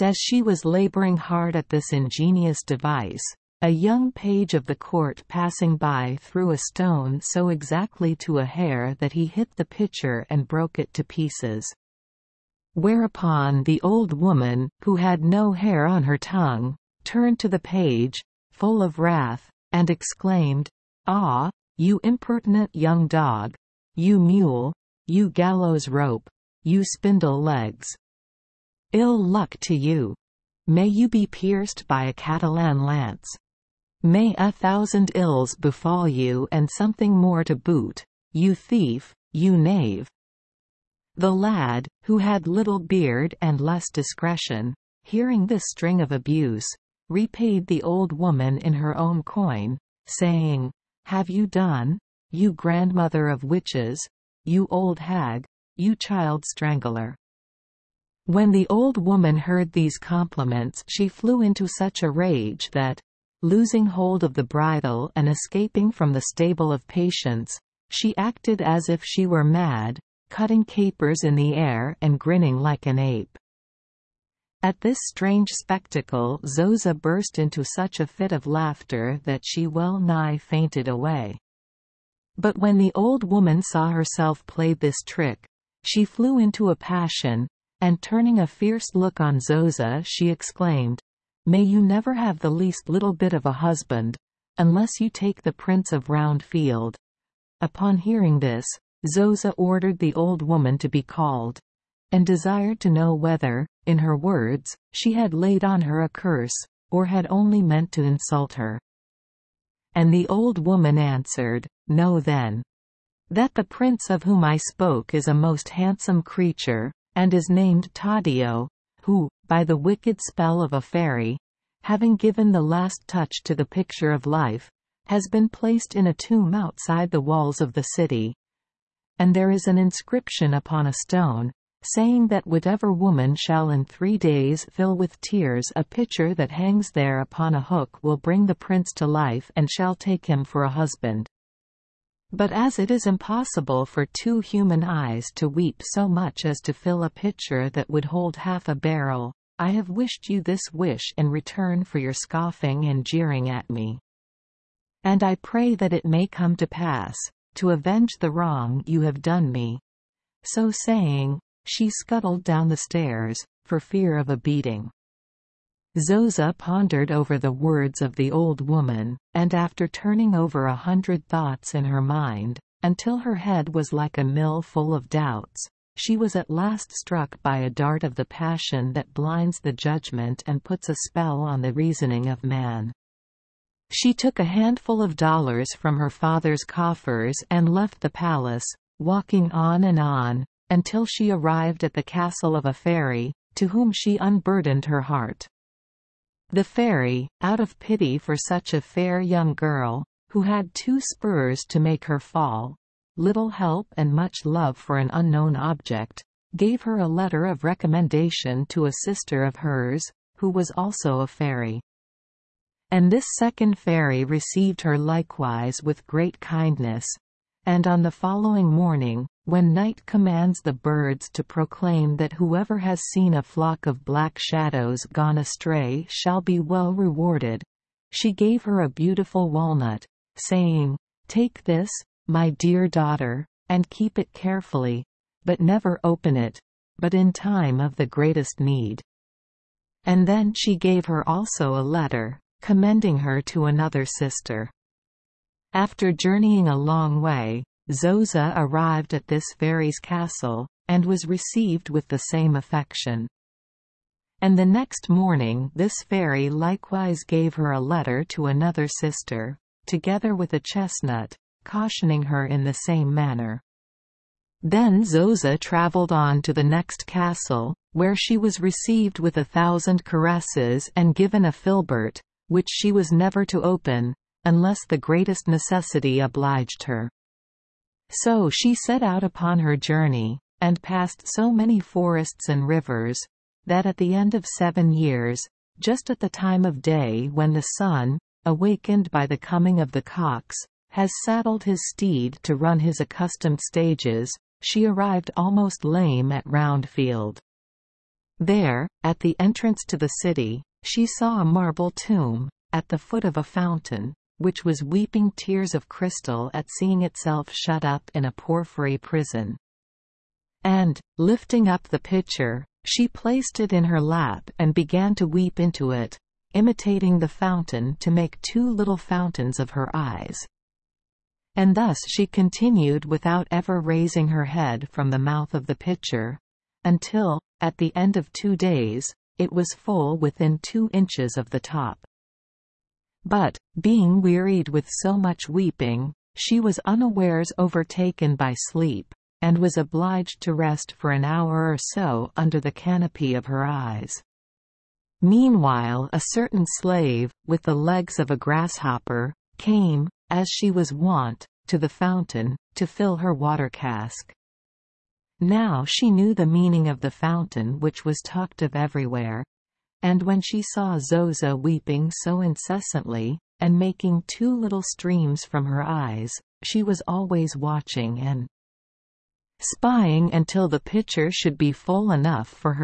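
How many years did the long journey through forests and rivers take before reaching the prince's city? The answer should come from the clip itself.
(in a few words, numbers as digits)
7.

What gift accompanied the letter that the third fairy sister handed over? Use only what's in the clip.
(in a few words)
A chestnut.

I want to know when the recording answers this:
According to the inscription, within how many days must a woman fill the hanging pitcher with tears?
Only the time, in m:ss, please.
2:13.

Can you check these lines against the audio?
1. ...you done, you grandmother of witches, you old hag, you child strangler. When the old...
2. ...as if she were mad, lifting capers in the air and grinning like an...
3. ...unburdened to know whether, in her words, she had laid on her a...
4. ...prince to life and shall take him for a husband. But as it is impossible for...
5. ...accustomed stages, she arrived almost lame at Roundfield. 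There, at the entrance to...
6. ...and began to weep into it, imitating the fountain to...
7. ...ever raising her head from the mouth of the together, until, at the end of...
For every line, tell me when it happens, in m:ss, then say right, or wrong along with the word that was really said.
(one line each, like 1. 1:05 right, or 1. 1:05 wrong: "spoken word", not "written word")
1. 0:51 right
2. 1:08 wrong: "cutting", not "lifting"
3. 1:42 wrong: "desired", not "unburdened"
4. 2:18 right
5. 4:52 right
6. 5:14 right
7. 5:23 wrong: "pitcher", not "together".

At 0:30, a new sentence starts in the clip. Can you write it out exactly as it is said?
May you be pierced by a Catalan lance!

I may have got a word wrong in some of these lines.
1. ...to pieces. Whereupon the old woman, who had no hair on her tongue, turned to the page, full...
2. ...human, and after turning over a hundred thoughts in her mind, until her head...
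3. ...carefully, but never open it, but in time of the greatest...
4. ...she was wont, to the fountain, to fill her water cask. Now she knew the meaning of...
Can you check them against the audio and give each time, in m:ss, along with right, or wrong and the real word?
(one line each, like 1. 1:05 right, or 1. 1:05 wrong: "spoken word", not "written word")
1. 0:10 right
2. 2:48 wrong: "woman", not "human"
3. 3:54 right
4. 5:50 right.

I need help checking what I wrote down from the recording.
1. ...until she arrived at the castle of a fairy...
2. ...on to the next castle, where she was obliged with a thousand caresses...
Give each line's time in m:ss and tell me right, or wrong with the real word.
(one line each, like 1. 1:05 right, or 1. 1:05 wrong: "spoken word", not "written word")
1. 3:10 right
2. 4:26 wrong: "received", not "obliged".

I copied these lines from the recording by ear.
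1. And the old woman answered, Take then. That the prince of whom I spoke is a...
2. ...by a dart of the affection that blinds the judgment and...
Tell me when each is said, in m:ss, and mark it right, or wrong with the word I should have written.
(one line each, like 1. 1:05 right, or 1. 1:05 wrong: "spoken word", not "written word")
1. 1:49 wrong: "Know", not "Take"
2. 2:57 wrong: "passion", not "affection".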